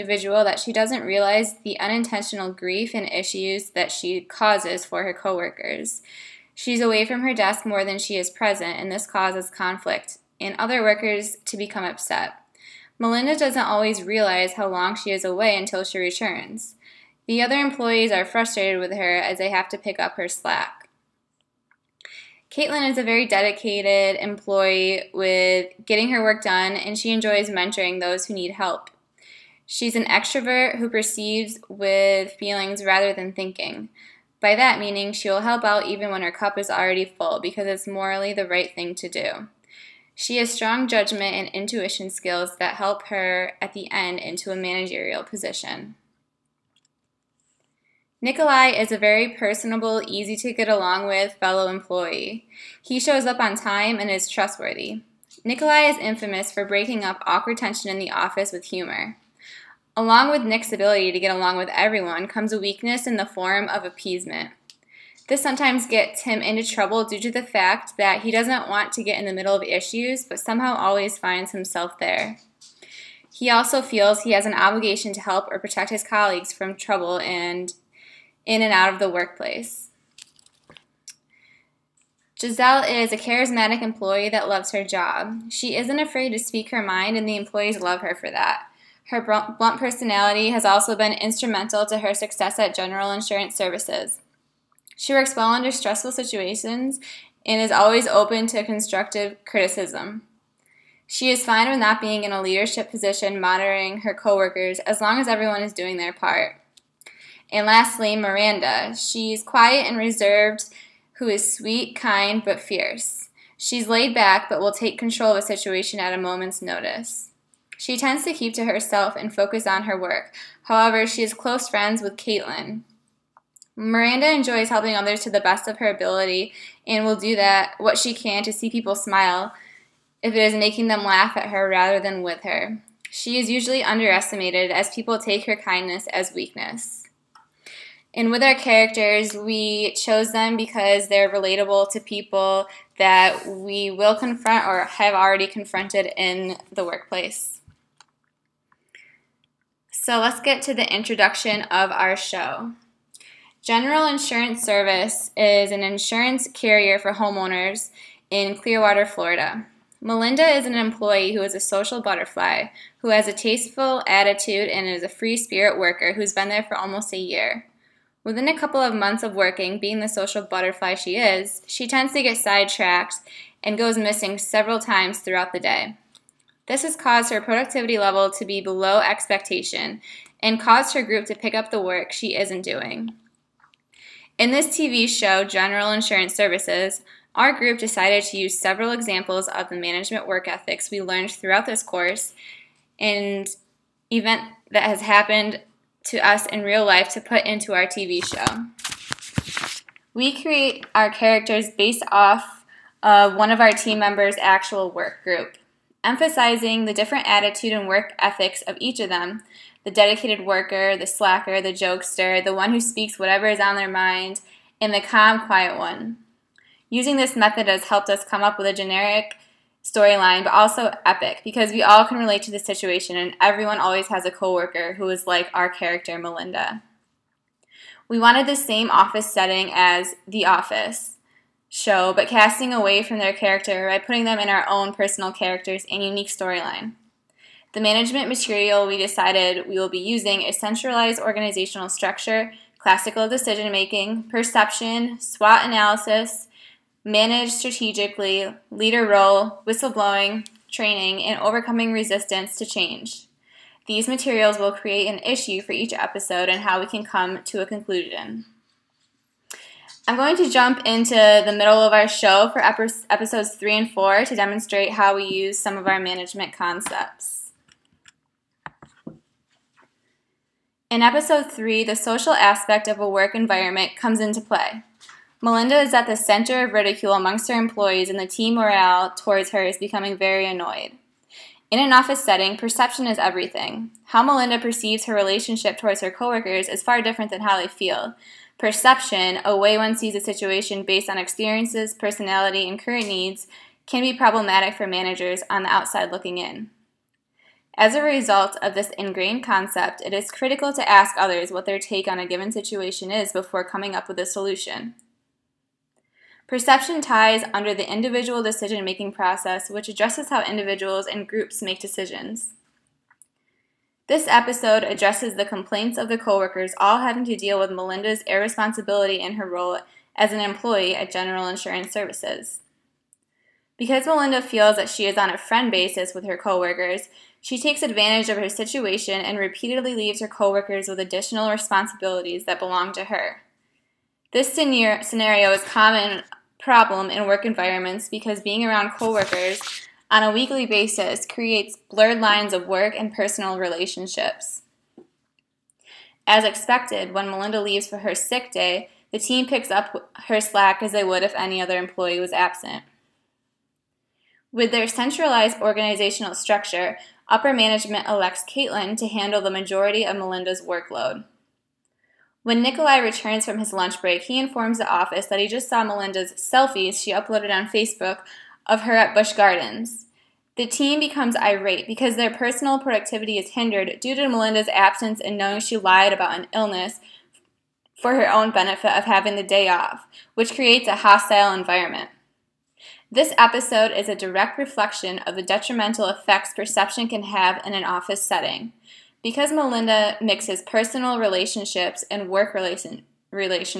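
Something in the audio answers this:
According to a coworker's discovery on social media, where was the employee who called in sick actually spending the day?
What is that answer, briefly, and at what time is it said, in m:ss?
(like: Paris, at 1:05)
Busch Gardens, at 6:09.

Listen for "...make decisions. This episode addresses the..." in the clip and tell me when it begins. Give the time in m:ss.
5:11.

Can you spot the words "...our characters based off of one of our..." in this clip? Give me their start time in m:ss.
3:20.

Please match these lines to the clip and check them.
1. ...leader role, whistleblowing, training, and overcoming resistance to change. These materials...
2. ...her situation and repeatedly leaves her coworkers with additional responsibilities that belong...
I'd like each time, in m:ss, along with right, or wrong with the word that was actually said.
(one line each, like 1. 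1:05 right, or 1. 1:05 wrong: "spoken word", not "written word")
1. 4:08 right
2. 5:28 right.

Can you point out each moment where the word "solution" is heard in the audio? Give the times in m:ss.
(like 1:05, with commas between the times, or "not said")
5:04.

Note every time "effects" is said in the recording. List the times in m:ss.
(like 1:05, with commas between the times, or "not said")
6:26.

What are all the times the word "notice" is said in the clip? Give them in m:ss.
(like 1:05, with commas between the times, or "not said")
1:56.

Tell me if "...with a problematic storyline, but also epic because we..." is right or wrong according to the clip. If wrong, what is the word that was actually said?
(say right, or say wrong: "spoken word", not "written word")
wrong: "generic", not "problematic".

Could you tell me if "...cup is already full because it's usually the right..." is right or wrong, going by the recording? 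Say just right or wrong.
wrong.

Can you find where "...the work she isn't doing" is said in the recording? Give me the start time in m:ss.
3:01.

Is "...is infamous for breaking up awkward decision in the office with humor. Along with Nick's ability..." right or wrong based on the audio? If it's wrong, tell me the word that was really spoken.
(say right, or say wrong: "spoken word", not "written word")
wrong: "tension", not "decision".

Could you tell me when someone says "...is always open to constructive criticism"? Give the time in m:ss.
1:37.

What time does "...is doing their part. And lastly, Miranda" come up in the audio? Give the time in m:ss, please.
1:45.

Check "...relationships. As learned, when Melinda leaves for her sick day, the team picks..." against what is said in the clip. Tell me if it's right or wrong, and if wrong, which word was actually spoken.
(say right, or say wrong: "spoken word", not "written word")
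wrong: "expected", not "learned".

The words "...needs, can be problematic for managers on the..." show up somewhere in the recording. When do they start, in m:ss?
4:53.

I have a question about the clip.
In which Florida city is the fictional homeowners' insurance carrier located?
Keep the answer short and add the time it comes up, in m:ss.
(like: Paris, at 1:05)
Clearwater, at 2:38.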